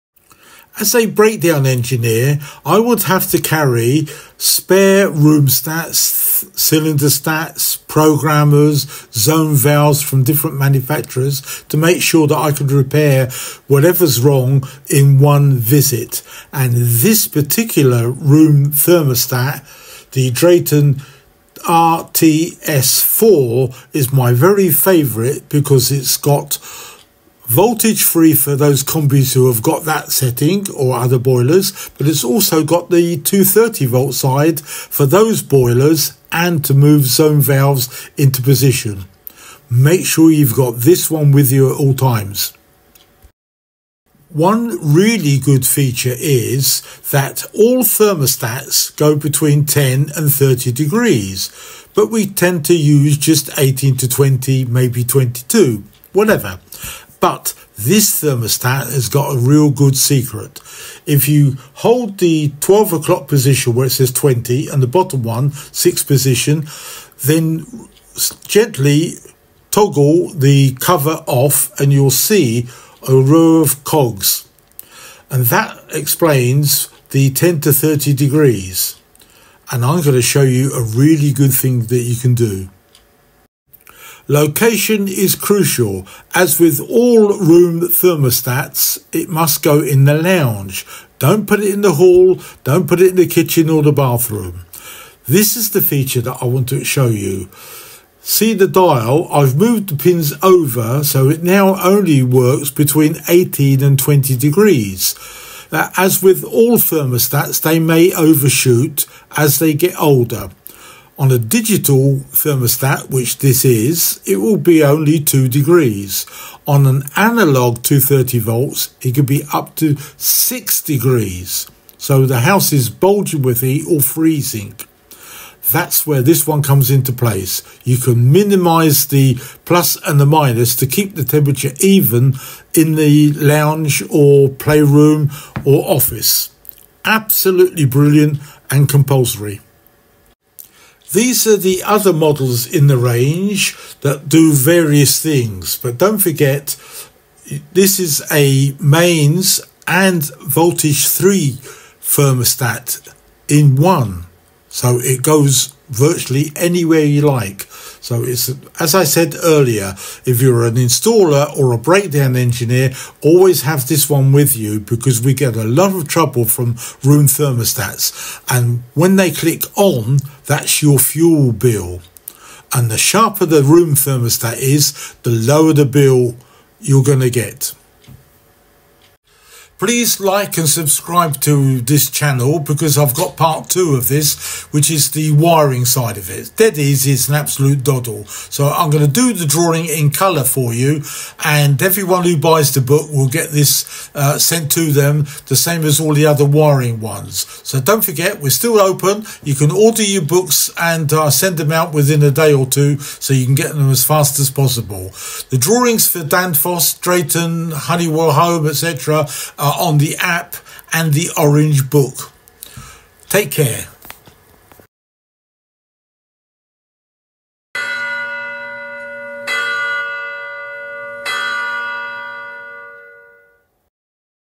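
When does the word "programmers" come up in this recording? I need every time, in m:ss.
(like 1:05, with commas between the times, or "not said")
0:07.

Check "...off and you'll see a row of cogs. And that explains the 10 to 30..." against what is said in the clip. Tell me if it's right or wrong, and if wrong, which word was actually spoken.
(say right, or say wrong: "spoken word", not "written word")
right.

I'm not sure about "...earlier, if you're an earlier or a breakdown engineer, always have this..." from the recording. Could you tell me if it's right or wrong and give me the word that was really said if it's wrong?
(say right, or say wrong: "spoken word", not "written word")
wrong: "installer", not "earlier".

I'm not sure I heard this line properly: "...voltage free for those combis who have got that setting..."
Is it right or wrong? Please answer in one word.
right.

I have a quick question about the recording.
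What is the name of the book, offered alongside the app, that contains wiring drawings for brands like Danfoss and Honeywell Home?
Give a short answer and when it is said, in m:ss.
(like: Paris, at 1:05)
The Orange Book, at 3:31.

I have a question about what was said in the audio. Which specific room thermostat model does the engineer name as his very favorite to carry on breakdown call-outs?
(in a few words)
Drayton RTS4.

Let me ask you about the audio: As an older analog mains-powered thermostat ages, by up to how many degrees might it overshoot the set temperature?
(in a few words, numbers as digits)
6 degrees.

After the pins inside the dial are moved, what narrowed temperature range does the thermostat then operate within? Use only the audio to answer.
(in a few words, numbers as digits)
18 to 20 degrees.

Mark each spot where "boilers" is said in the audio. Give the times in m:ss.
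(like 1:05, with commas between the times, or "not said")
0:31, 0:35.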